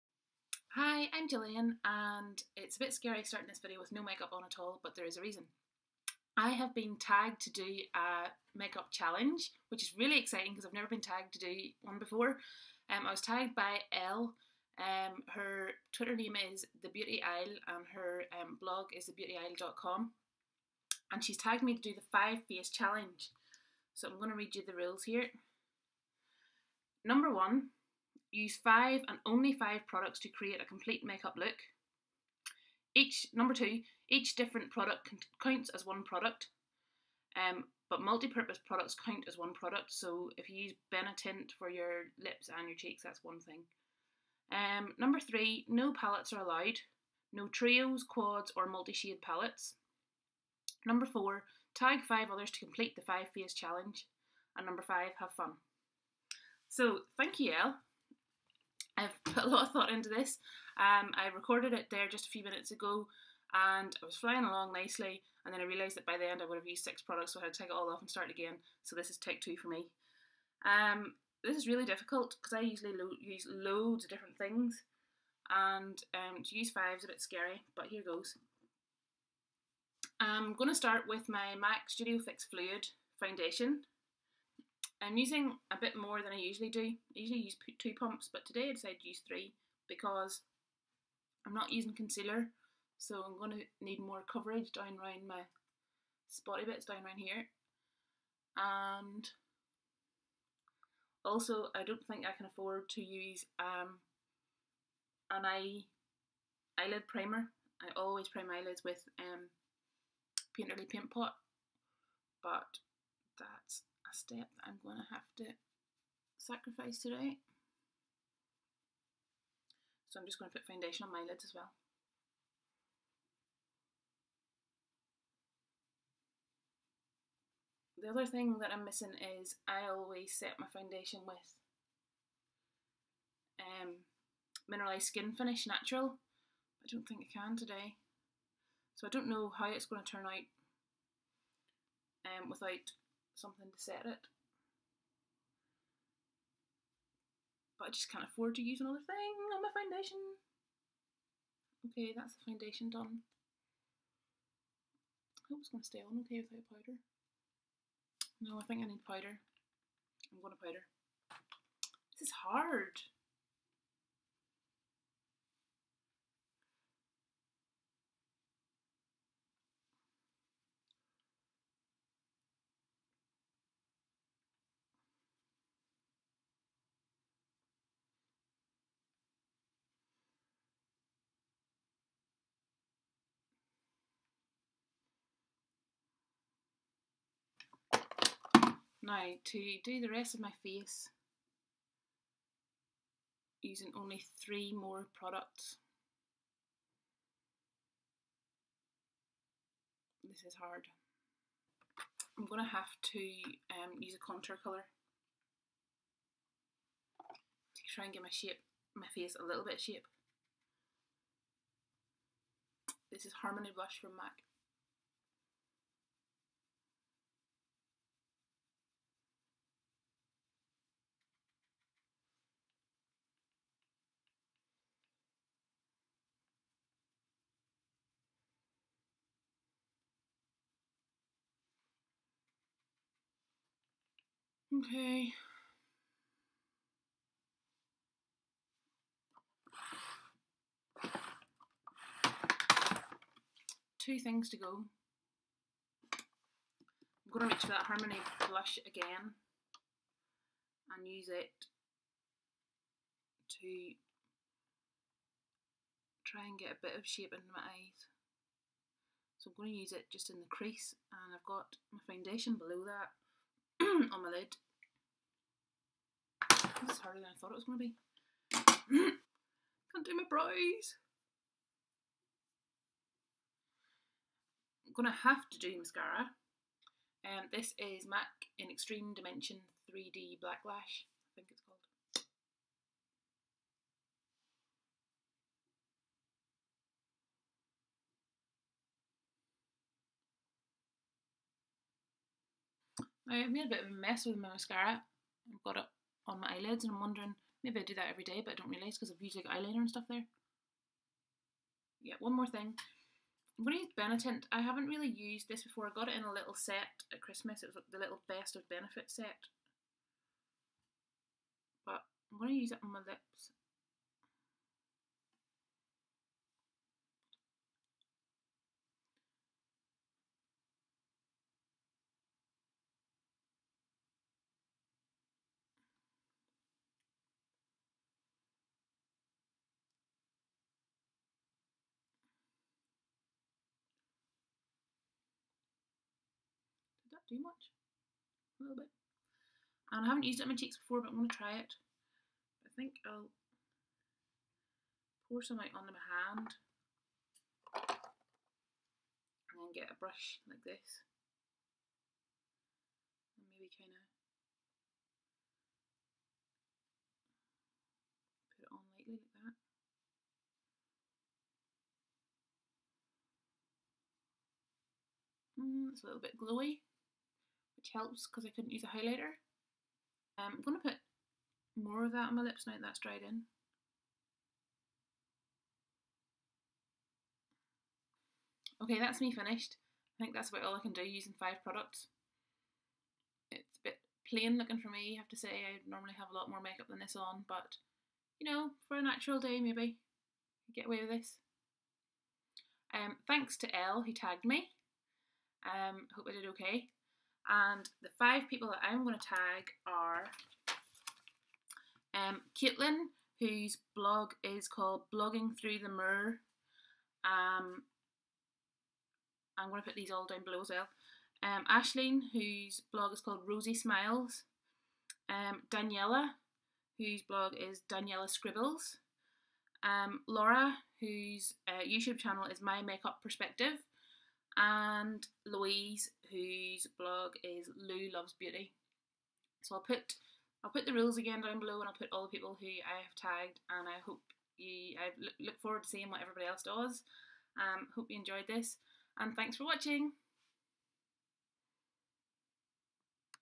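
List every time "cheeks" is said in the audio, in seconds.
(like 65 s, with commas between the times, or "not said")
42 s, 340 s.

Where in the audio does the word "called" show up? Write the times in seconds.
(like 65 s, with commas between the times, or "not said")
281 s, 404 s, 413 s.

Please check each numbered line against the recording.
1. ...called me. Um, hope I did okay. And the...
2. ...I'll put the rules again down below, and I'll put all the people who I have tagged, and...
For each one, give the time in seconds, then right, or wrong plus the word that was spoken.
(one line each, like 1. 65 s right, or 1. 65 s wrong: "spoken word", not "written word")
1. 394 s wrong: "tagged", not "called"
2. 430 s right.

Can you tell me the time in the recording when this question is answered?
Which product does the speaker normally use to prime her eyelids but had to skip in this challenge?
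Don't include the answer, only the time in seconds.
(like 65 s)
110 s.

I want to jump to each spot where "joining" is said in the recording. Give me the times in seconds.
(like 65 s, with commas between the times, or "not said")
not said.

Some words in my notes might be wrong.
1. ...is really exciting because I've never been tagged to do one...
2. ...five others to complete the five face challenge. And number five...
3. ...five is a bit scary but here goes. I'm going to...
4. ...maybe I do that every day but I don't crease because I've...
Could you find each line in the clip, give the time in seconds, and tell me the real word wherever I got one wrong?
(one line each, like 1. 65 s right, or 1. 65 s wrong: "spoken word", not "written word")
1. 9 s right
2. 52 s right
3. 76 s right
4. 297 s wrong: "realise", not "crease".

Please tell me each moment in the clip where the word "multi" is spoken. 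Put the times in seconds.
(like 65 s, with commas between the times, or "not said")
38 s, 48 s.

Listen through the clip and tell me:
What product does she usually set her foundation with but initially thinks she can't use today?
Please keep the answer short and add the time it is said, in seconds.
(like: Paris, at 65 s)
Mineralized Skin Finish Natural, at 134 s.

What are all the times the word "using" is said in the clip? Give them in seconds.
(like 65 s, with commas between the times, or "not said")
85 s, 91 s, 193 s, 381 s.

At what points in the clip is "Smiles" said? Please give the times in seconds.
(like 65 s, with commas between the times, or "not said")
413 s.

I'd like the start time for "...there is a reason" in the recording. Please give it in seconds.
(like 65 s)
4 s.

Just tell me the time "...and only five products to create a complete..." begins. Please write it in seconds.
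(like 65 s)
29 s.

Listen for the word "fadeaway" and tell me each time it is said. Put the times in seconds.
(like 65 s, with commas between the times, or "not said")
not said.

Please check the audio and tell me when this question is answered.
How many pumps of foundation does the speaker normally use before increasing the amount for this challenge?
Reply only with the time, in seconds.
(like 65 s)
87 s.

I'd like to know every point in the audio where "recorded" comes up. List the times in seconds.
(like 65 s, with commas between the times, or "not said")
61 s.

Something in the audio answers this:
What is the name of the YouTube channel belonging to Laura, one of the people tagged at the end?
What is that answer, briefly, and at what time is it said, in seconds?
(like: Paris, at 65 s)
My Makeup Perspective, at 422 s.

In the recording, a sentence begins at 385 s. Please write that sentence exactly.
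I normally have a lot more makeup than this on, but you know, for a natural day maybe, get away with this.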